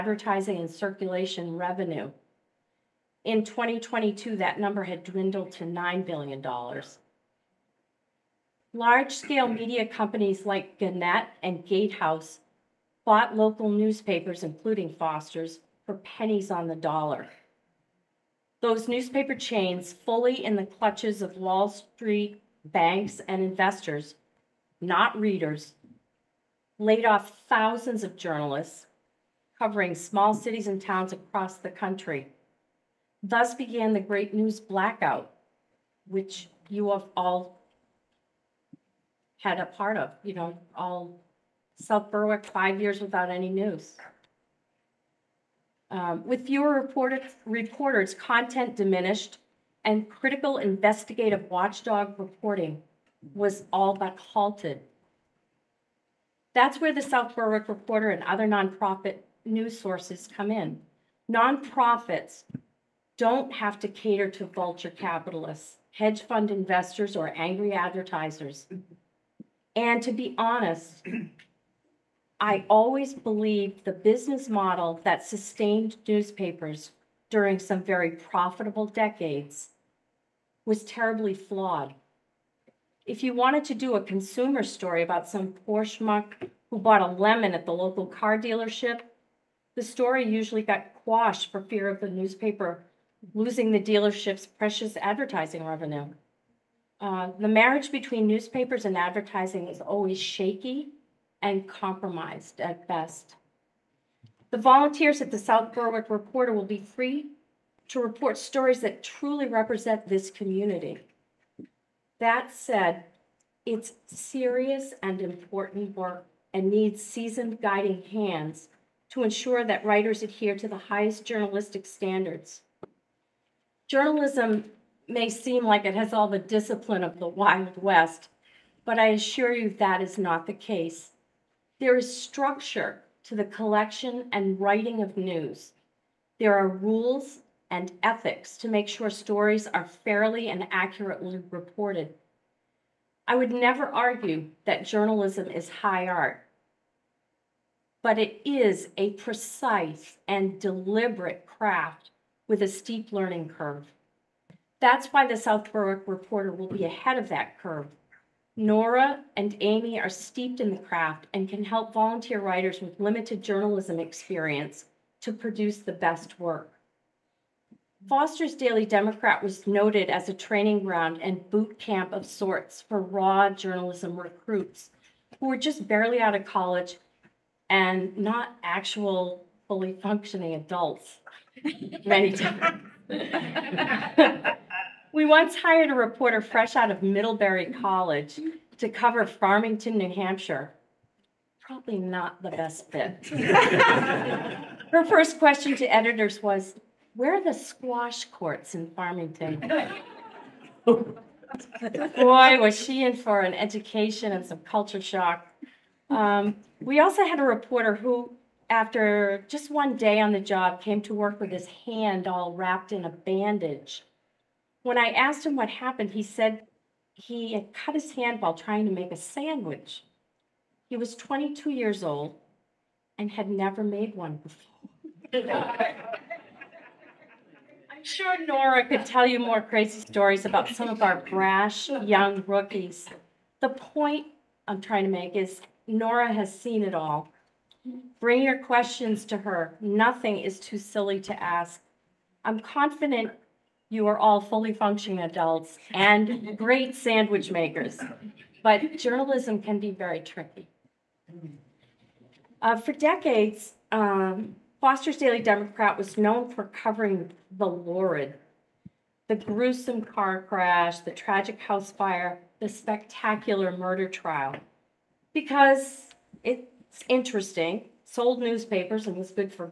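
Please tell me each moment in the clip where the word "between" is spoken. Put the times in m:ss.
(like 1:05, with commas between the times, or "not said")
1:37.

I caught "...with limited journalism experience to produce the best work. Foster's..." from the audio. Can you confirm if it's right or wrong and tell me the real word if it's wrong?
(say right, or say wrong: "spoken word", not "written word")
right.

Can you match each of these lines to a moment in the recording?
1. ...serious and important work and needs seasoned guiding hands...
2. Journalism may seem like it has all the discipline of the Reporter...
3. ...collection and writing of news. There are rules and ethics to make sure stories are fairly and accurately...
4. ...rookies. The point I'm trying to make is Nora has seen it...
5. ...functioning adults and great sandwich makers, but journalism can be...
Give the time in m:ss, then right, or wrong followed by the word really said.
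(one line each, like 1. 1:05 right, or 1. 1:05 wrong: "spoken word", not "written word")
1. 1:54 right
2. 2:03 wrong: "Wild", not "Reporter"
3. 2:13 right
4. 3:52 right
5. 4:04 right.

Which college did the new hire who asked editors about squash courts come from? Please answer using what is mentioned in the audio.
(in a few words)
Middlebury College.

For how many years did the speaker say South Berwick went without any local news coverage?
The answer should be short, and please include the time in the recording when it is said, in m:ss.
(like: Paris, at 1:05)
5 years, at 0:42.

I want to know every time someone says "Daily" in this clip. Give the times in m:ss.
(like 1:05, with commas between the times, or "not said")
2:48, 4:15.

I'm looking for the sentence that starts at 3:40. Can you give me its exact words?
He was 22 years old and had never made one before.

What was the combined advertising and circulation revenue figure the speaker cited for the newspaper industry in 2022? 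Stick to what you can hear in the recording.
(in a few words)
$9 billion.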